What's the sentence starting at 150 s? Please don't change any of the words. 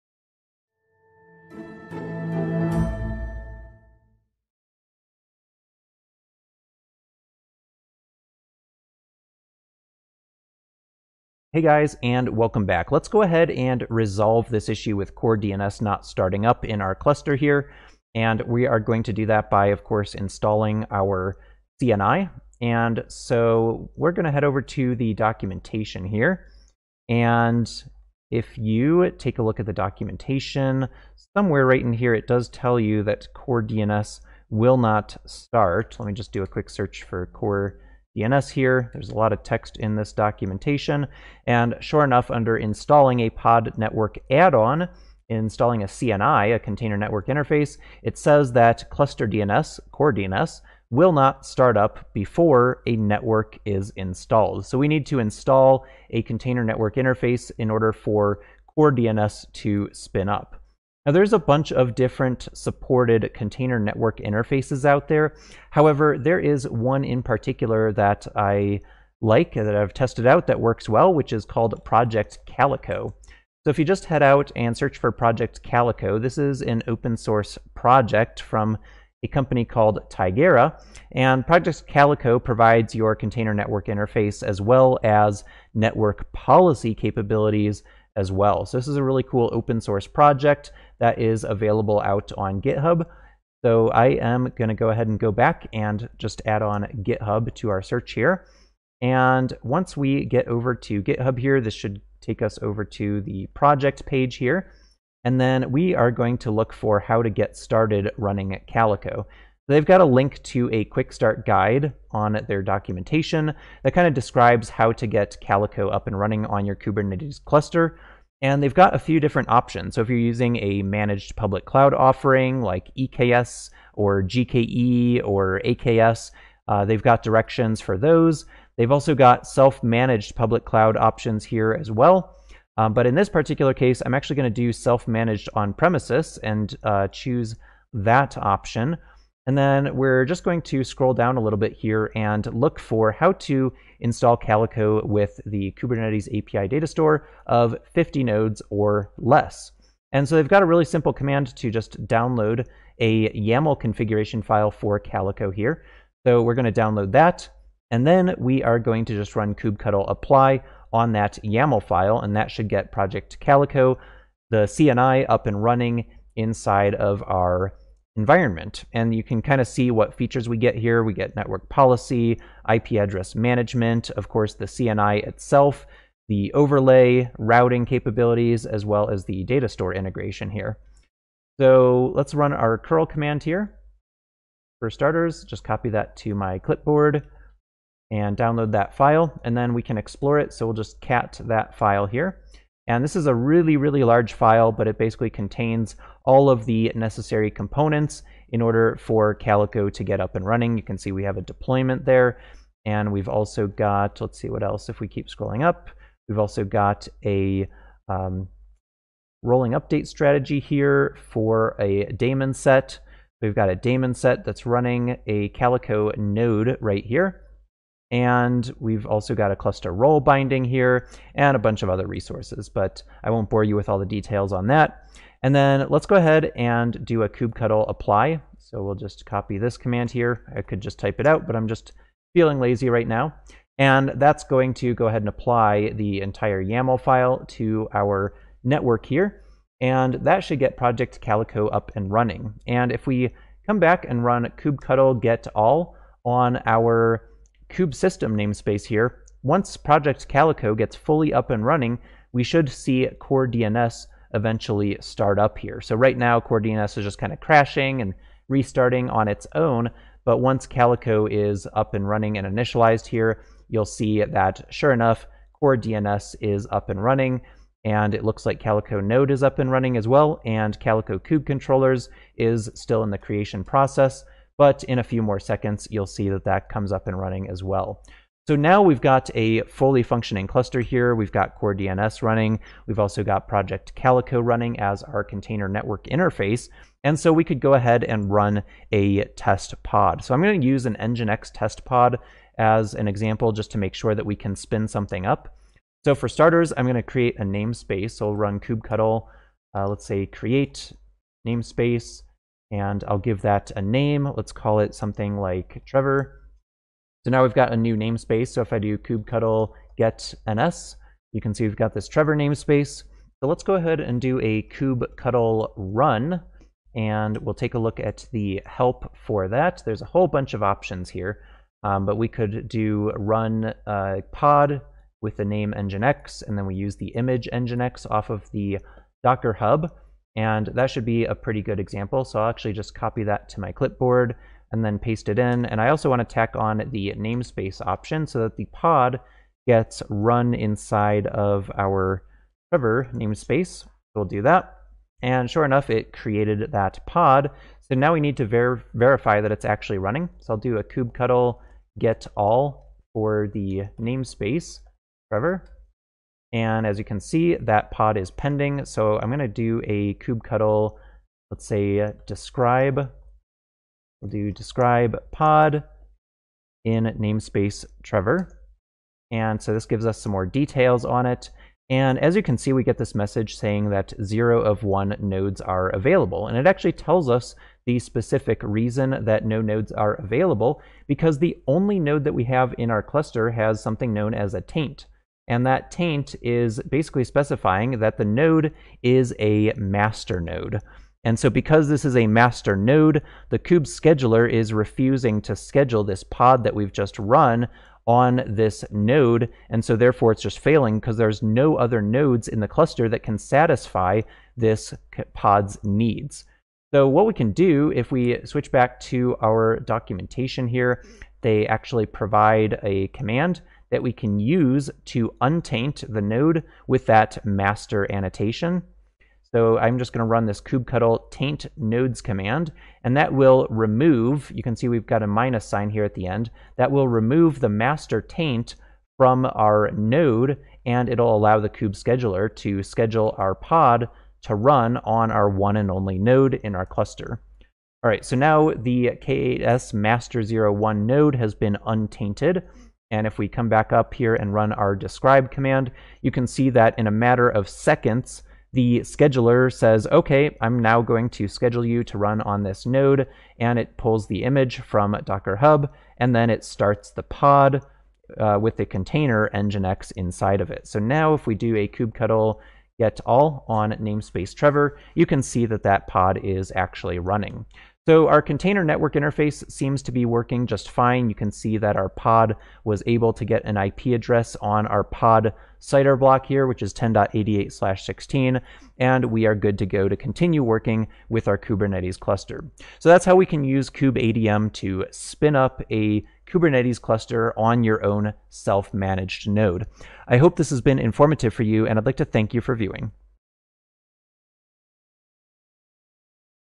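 And so they've got a really simple command to just download a YAML configuration file for Calico here.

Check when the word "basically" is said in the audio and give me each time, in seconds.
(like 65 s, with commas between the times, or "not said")
194 s, 386 s.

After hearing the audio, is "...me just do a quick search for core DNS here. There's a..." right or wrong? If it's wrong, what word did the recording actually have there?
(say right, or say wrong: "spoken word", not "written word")
right.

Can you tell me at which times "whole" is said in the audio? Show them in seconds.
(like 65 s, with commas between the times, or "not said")
320 s.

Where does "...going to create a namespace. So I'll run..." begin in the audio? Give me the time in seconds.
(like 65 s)
296 s.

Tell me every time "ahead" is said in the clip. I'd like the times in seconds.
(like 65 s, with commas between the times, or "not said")
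13 s, 94 s, 226 s, 235 s, 287 s, 313 s.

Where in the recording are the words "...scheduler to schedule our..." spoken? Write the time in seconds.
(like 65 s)
432 s.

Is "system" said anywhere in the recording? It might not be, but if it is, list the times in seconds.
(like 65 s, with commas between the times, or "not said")
247 s.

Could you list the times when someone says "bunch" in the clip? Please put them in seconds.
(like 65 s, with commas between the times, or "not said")
61 s, 221 s, 320 s.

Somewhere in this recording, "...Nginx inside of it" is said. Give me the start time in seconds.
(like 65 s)
459 s.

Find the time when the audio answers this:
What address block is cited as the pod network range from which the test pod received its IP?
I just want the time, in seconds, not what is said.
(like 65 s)
476 s.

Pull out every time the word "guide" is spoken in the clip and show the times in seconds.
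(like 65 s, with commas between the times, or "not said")
111 s.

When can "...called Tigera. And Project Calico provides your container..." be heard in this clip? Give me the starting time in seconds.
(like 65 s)
79 s.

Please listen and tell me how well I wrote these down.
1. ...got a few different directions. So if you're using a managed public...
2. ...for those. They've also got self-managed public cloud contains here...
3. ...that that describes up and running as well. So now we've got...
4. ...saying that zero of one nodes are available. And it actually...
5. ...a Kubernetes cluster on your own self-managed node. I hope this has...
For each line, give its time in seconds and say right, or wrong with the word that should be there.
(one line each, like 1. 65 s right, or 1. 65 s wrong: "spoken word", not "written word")
1. 118 s wrong: "options", not "directions"
2. 127 s wrong: "options", not "contains"
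3. 276 s wrong: "comes", not "describes"
4. 373 s right
5. 485 s right.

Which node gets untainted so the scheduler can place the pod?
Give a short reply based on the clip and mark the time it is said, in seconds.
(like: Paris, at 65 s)
K8S master01, at 439 s.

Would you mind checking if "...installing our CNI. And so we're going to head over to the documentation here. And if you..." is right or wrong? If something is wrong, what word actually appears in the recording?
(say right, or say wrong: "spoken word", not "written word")
right.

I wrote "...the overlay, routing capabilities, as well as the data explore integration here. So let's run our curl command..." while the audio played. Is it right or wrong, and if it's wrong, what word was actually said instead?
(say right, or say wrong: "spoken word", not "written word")
wrong: "store", not "explore".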